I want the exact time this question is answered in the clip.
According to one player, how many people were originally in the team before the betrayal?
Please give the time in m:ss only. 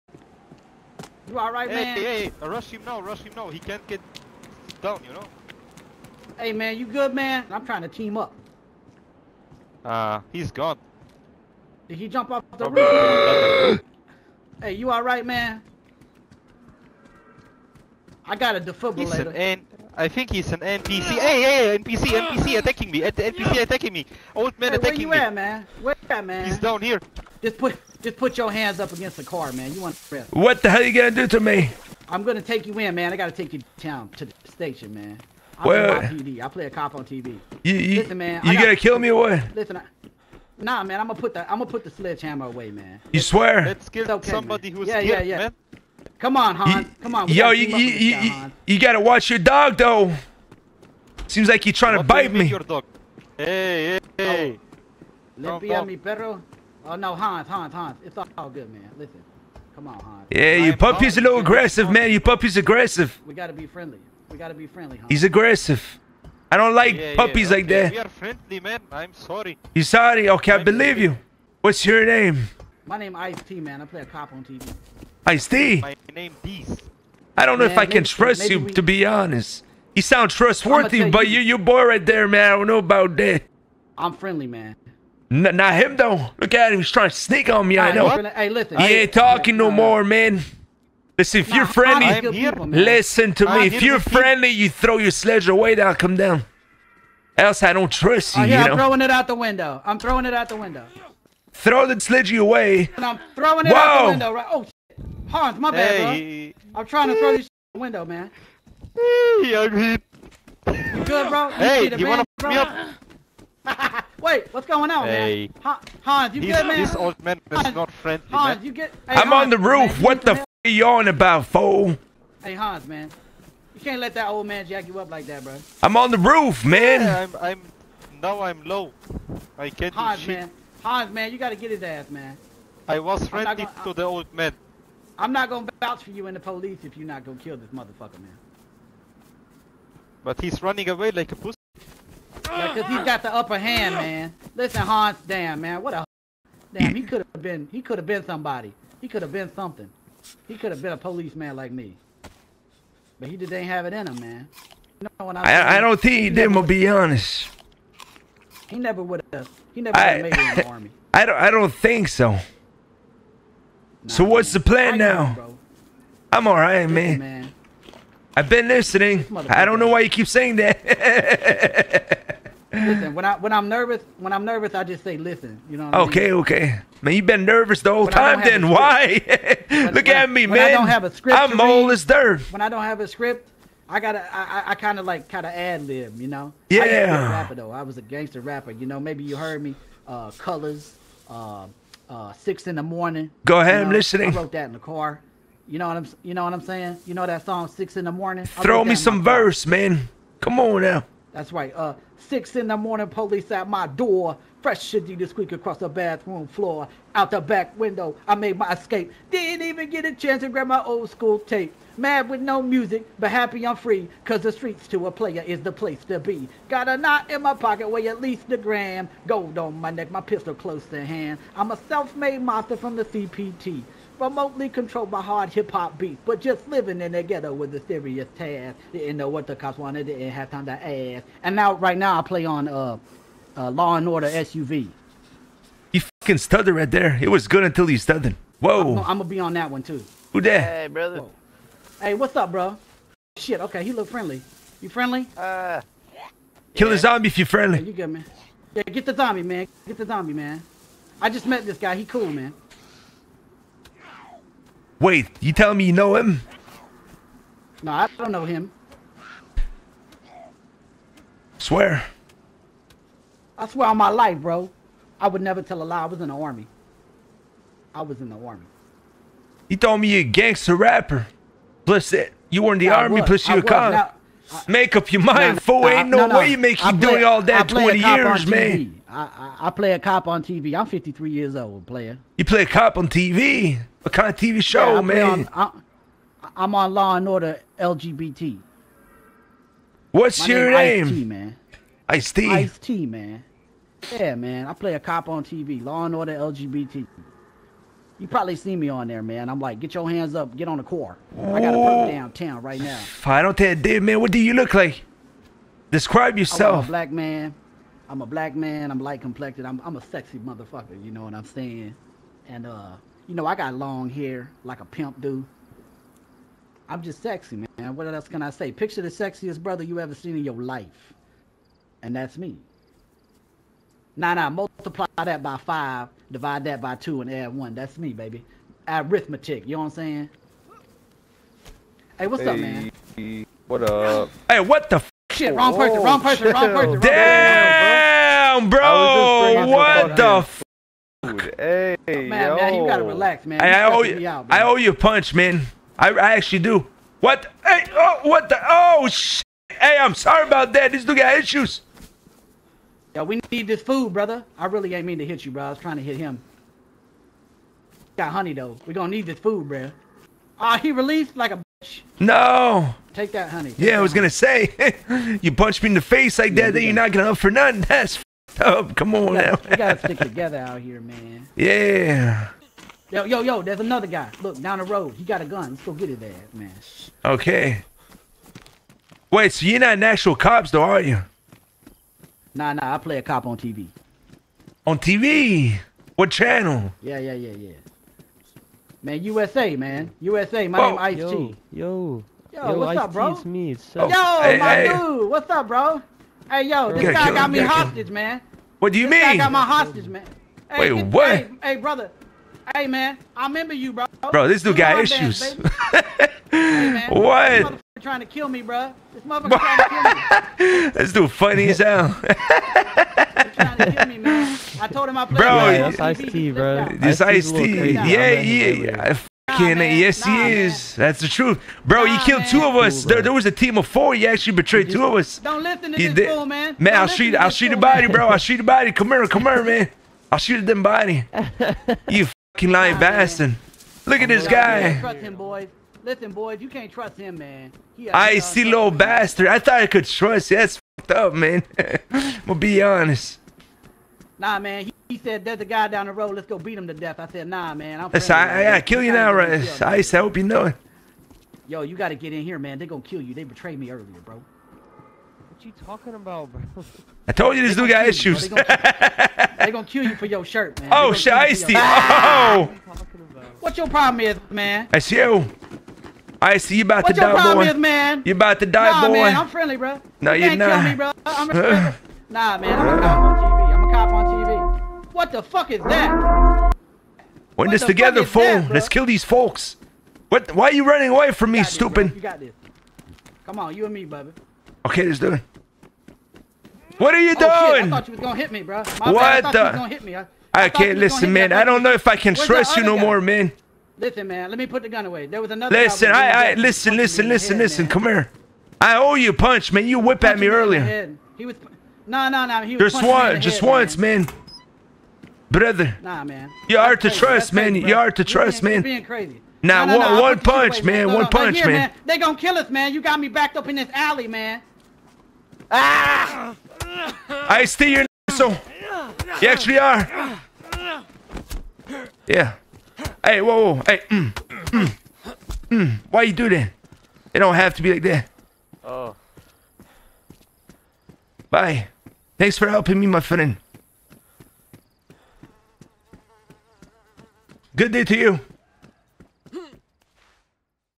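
7:03.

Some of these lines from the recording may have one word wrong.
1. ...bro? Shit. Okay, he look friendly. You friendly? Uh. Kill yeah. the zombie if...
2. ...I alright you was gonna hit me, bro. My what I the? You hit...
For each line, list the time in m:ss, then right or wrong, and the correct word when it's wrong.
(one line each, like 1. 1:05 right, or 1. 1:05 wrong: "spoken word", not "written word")
1. 4:02 right
2. 8:07 wrong: "thought", not "alright".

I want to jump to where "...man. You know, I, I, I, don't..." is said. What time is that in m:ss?
2:34.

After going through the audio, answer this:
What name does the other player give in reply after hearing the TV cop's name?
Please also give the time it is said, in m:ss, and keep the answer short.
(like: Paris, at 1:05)
Beast, at 1:15.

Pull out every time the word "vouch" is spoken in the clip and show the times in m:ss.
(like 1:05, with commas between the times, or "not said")
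2:15.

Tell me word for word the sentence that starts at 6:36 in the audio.
Hey, yo, this guy kill, got me hostage, kill.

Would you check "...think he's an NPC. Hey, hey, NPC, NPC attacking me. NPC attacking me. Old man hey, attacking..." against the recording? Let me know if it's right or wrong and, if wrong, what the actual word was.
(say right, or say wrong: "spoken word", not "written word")
right.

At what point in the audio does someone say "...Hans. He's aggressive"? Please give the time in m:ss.
1:04.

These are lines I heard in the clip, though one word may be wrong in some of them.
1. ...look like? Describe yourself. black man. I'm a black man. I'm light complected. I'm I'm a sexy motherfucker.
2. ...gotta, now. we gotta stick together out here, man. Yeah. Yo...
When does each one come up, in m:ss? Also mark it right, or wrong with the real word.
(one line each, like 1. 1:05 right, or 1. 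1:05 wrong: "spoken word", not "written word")
1. 5:04 right
2. 6:09 right.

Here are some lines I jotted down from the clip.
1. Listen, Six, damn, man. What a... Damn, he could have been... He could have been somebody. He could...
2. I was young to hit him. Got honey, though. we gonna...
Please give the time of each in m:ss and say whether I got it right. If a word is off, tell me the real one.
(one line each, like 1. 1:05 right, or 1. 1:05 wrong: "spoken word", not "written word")
1. 2:24 wrong: "Hans", not "Six"
2. 5:55 wrong: "trying", not "young".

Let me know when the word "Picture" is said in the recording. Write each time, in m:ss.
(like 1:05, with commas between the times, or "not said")
5:18.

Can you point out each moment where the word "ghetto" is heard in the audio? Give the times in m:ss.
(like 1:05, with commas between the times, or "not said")
3:47.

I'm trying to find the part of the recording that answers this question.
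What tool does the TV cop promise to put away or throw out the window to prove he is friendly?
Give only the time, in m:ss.
0:41.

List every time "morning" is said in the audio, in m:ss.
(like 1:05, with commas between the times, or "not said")
3:12, 3:18, 3:22.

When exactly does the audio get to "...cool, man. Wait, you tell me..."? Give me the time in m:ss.
4:12.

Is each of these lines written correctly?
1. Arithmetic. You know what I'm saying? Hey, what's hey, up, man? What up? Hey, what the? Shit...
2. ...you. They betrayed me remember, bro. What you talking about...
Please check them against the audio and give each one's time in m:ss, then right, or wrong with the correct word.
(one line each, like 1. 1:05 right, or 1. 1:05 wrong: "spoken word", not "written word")
1. 5:28 right
2. 7:33 wrong: "earlier", not "remember".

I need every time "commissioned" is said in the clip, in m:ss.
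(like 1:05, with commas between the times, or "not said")
not said.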